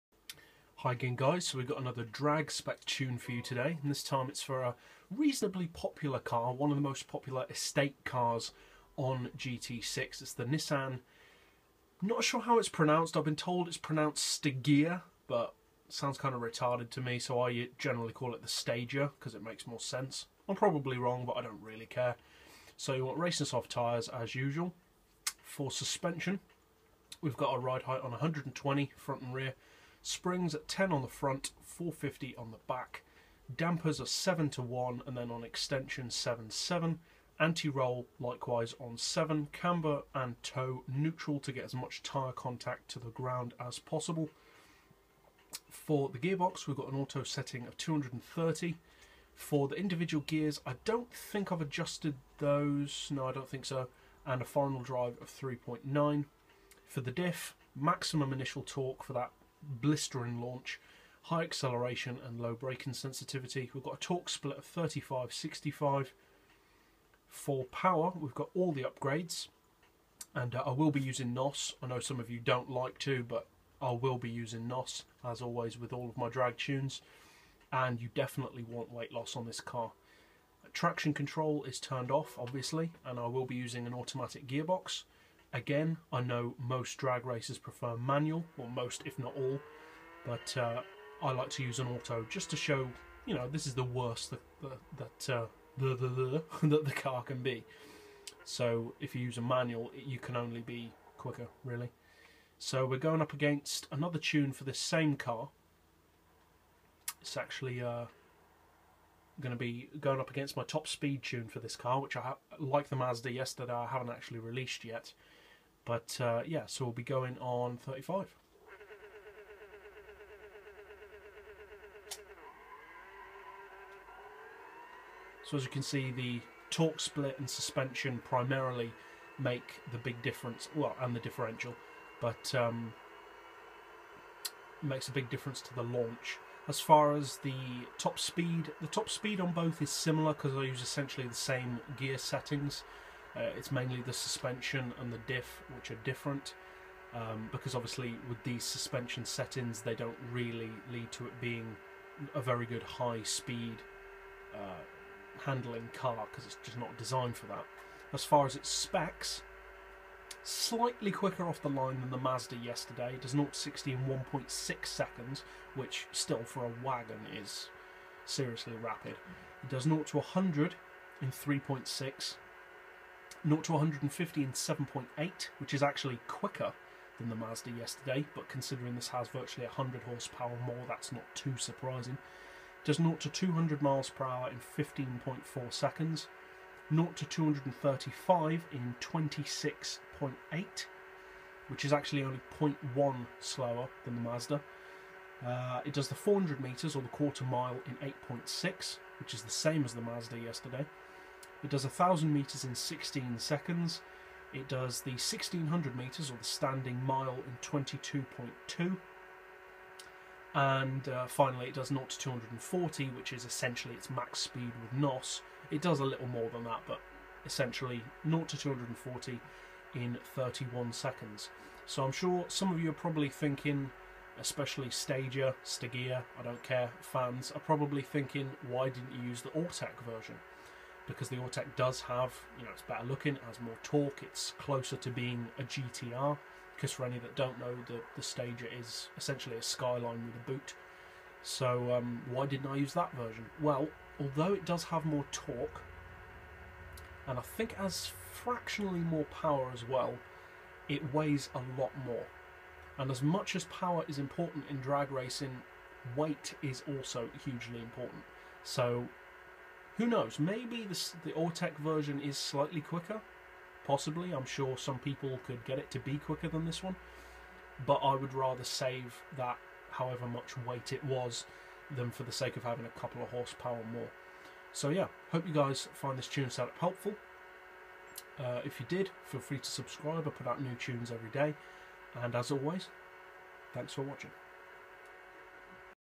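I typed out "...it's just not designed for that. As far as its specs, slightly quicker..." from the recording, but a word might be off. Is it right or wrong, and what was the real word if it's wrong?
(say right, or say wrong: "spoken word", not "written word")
right.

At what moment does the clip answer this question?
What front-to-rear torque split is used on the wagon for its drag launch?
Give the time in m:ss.
1:04.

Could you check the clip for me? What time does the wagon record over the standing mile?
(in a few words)
22.2.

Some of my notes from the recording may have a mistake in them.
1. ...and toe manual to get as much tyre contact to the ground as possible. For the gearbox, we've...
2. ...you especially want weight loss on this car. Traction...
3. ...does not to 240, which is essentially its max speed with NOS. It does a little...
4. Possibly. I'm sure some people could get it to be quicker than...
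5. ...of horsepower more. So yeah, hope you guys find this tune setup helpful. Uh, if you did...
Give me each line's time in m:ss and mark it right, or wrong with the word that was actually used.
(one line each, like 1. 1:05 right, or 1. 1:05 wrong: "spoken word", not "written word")
1. 0:40 wrong: "neutral", not "manual"
2. 1:18 wrong: "definitely", not "especially"
3. 3:31 right
4. 4:23 right
5. 4:33 right.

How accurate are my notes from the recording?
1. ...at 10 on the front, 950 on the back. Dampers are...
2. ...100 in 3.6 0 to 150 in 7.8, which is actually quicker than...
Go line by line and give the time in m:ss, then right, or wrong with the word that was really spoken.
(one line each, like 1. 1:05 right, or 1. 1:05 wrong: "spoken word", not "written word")
1. 0:30 wrong: "450", not "950"
2. 2:50 right.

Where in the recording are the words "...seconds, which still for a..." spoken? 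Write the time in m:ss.
2:44.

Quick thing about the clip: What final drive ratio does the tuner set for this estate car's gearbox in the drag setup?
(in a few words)
3.9.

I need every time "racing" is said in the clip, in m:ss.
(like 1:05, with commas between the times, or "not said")
0:23, 4:15.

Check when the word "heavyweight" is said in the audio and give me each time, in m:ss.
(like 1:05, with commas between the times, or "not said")
not said.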